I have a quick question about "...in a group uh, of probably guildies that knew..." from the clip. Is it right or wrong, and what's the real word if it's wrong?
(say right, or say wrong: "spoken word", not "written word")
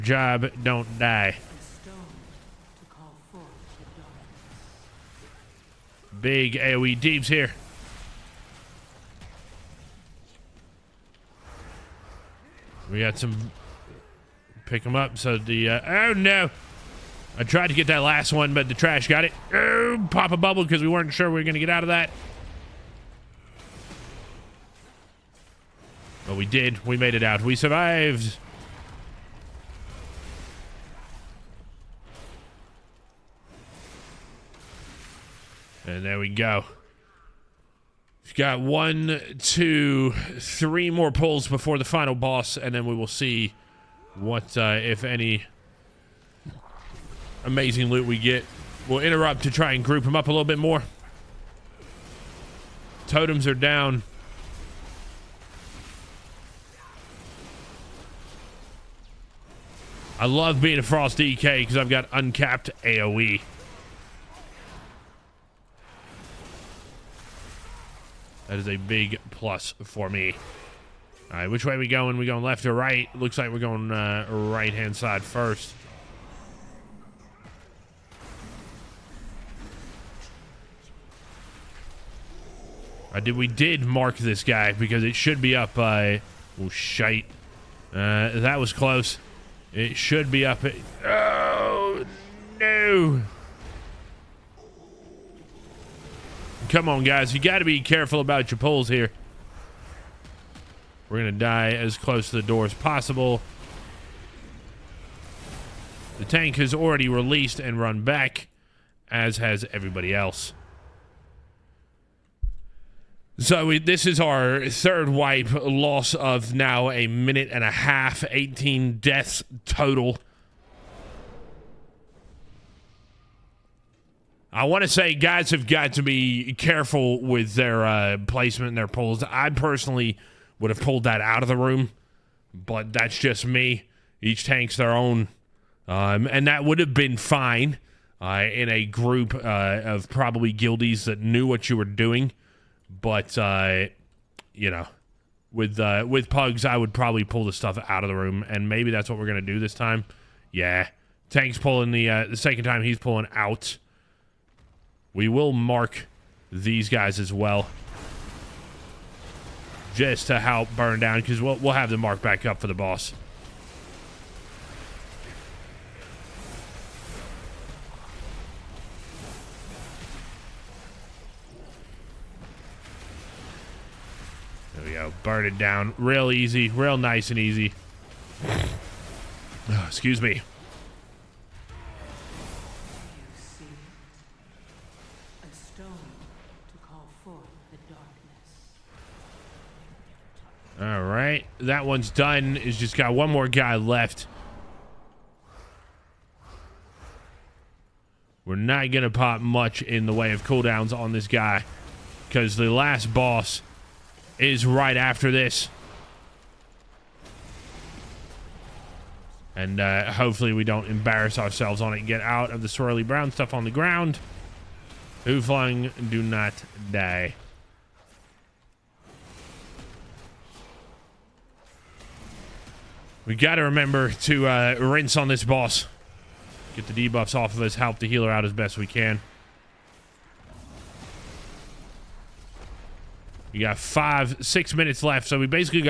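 right.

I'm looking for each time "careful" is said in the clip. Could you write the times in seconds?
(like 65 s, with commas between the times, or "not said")
97 s, 126 s.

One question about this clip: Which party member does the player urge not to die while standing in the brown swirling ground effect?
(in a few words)
WhoFlung.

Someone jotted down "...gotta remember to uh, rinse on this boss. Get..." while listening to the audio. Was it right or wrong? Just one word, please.
right.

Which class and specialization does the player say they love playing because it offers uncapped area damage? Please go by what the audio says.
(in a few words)
Frost DK.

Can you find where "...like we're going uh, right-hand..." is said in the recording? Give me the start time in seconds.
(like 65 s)
73 s.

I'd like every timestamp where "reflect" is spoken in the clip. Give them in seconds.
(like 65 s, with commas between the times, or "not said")
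not said.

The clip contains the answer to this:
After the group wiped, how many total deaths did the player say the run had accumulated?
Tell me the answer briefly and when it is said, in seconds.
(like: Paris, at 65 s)
18, at 118 s.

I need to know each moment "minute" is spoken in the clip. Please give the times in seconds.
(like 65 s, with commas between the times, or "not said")
117 s, 234 s.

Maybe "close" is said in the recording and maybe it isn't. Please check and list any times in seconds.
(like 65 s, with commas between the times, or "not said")
88 s, 101 s.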